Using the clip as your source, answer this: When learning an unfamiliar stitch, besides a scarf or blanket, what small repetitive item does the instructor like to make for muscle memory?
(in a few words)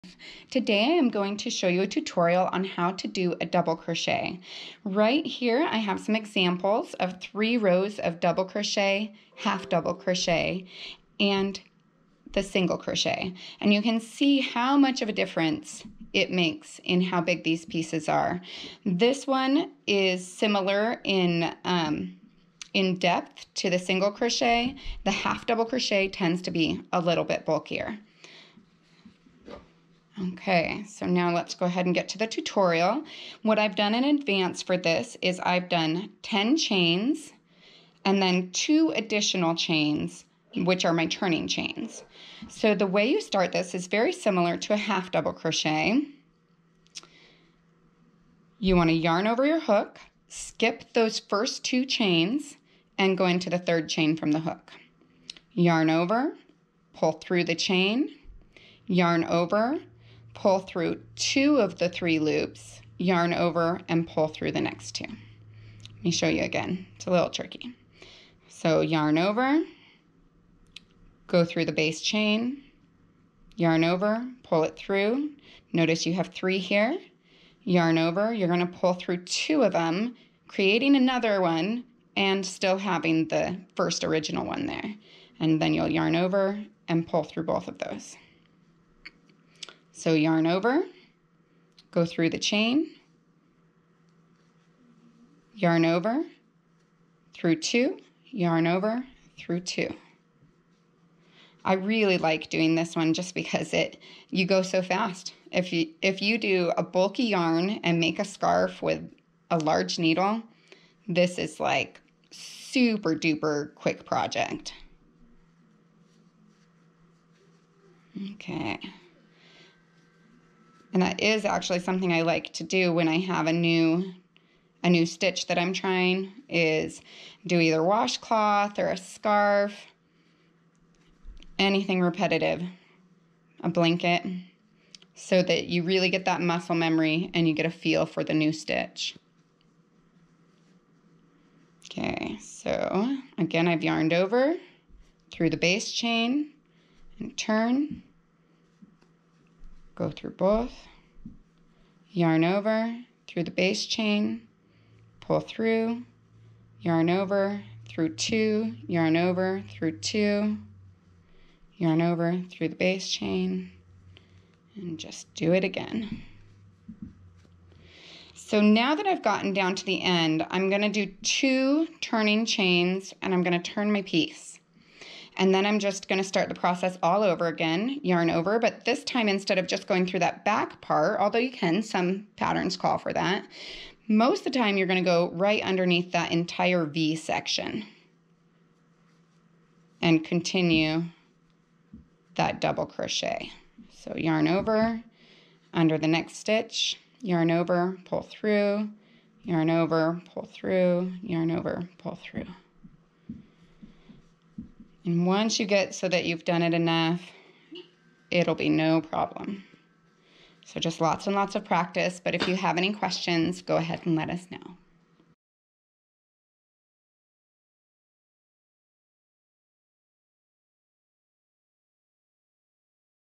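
Washcloth.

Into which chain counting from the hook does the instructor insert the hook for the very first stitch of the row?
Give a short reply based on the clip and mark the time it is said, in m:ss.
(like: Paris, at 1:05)
Third chain, at 0:53.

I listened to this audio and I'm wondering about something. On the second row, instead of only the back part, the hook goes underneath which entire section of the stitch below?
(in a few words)
V section.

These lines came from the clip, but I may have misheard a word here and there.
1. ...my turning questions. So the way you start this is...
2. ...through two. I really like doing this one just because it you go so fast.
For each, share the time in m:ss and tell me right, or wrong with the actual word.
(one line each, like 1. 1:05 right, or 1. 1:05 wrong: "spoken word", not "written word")
1. 0:40 wrong: "chains", not "questions"
2. 1:39 right.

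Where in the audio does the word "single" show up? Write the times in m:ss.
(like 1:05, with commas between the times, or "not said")
0:12, 0:23.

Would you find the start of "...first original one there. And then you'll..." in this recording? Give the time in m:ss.
1:23.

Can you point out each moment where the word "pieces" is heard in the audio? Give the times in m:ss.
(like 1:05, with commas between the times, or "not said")
0:17, 2:54.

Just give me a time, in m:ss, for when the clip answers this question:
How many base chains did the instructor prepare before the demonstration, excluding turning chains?
0:36.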